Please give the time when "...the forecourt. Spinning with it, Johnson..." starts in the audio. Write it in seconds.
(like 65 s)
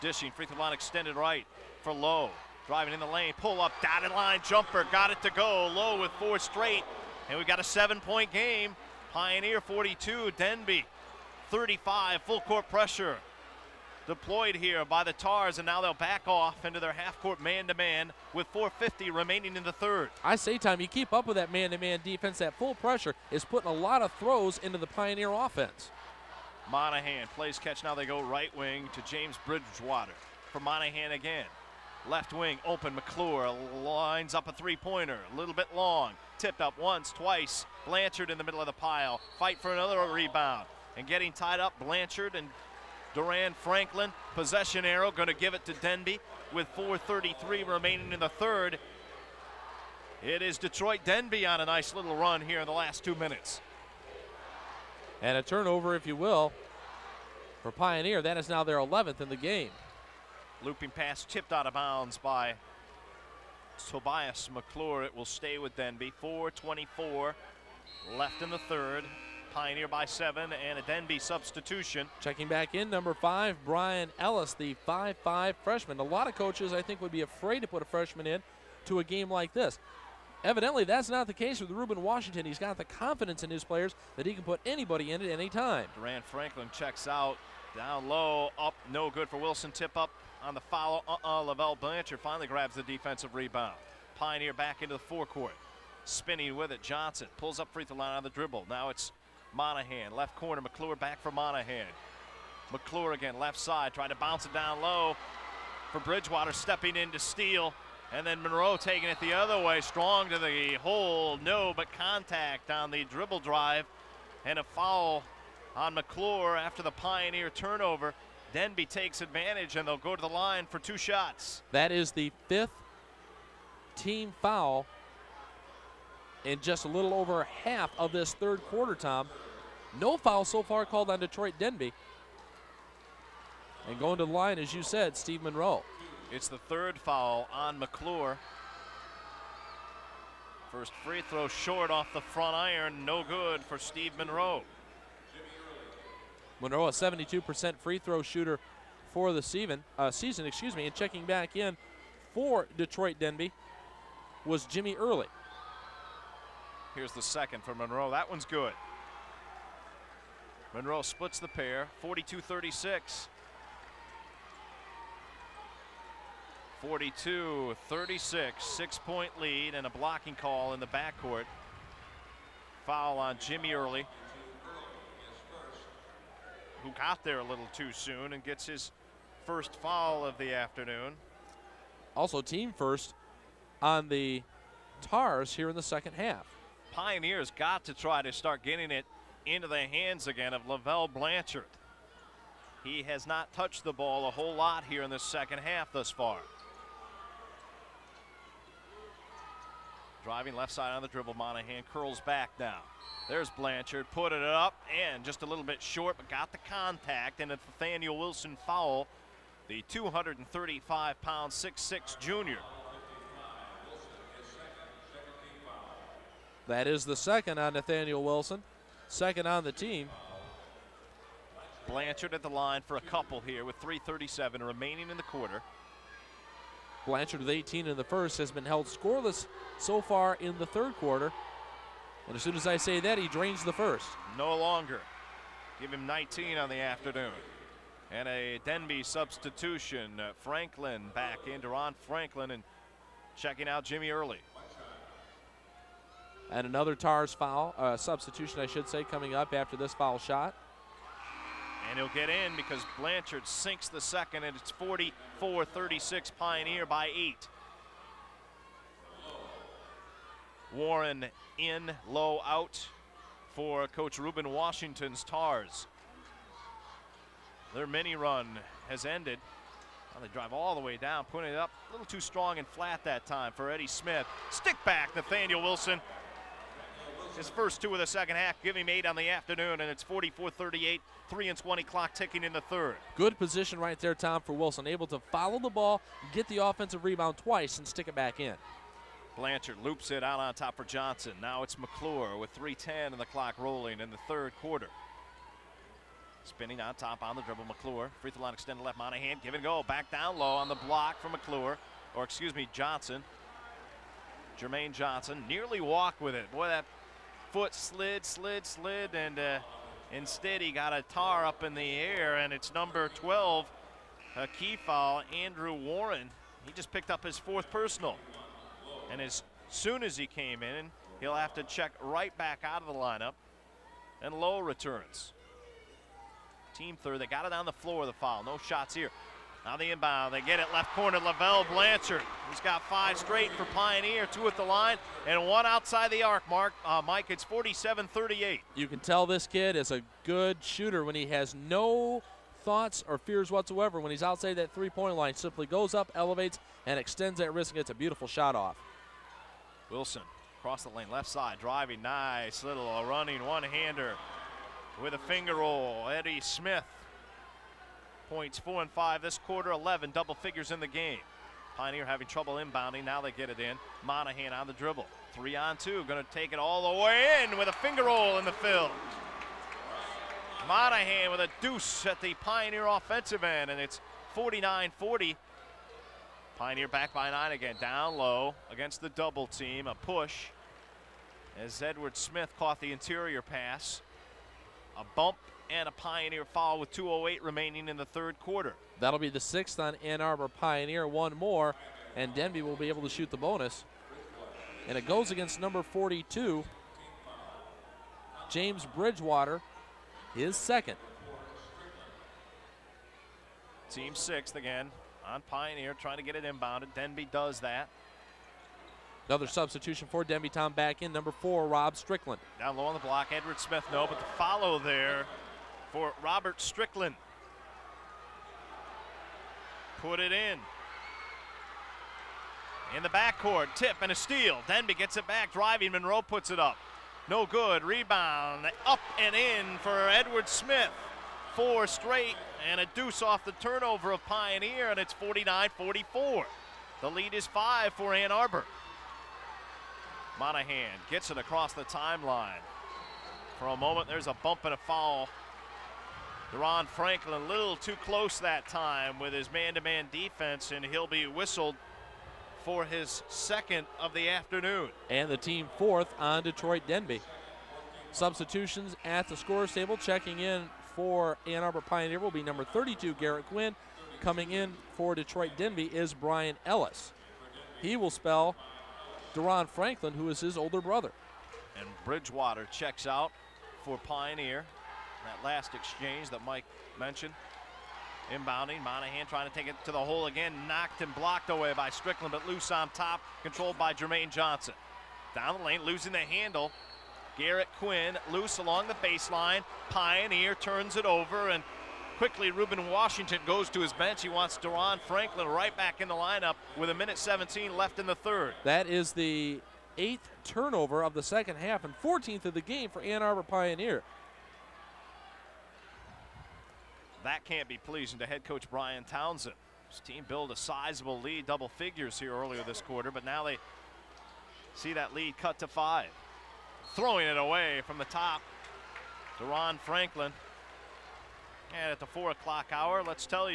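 94 s.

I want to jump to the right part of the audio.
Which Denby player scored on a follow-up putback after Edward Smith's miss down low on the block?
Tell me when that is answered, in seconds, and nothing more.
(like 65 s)
416 s.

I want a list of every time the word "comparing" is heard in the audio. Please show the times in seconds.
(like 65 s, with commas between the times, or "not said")
not said.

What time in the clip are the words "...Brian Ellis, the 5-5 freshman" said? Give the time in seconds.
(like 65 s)
73 s.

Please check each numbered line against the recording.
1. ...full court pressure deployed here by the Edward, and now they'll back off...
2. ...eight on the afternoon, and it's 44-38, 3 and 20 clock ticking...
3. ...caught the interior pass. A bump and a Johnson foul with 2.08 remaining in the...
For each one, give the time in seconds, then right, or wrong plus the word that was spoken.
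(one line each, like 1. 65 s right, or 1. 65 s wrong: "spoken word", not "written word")
1. 12 s wrong: "Tars", not "Edward"
2. 278 s right
3. 382 s wrong: "Pioneer", not "Johnson".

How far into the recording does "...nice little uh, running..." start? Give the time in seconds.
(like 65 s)
352 s.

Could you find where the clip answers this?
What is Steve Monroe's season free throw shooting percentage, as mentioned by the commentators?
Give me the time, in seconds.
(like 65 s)
146 s.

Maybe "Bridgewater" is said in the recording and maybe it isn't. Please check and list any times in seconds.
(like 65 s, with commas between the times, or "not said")
29 s, 105 s, 398 s, 472 s.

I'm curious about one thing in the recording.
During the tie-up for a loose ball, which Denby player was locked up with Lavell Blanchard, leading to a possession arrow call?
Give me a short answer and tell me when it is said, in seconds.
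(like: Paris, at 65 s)
Duran Franklin, at 43 s.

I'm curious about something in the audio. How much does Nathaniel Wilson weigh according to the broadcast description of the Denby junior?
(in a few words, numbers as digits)
235 pounds.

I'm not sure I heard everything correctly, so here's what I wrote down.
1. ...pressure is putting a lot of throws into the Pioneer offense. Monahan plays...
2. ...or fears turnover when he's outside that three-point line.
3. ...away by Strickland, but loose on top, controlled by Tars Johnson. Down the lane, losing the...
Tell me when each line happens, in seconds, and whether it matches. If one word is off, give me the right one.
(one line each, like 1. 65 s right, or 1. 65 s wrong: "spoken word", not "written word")
1. 22 s right
2. 343 s wrong: "whatsoever", not "turnover"
3. 481 s wrong: "Jermaine", not "Tars".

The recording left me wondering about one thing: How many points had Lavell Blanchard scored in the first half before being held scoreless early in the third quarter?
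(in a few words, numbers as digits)
18.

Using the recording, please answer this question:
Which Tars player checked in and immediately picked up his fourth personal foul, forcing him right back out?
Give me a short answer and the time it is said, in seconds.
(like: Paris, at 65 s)
Andrew Warren, at 315 s.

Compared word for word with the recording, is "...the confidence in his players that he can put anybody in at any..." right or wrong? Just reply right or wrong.
right.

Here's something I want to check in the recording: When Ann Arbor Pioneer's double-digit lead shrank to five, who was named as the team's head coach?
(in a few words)
Brian Townsend.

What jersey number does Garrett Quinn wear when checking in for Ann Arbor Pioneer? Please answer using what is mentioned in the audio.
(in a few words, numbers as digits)
32.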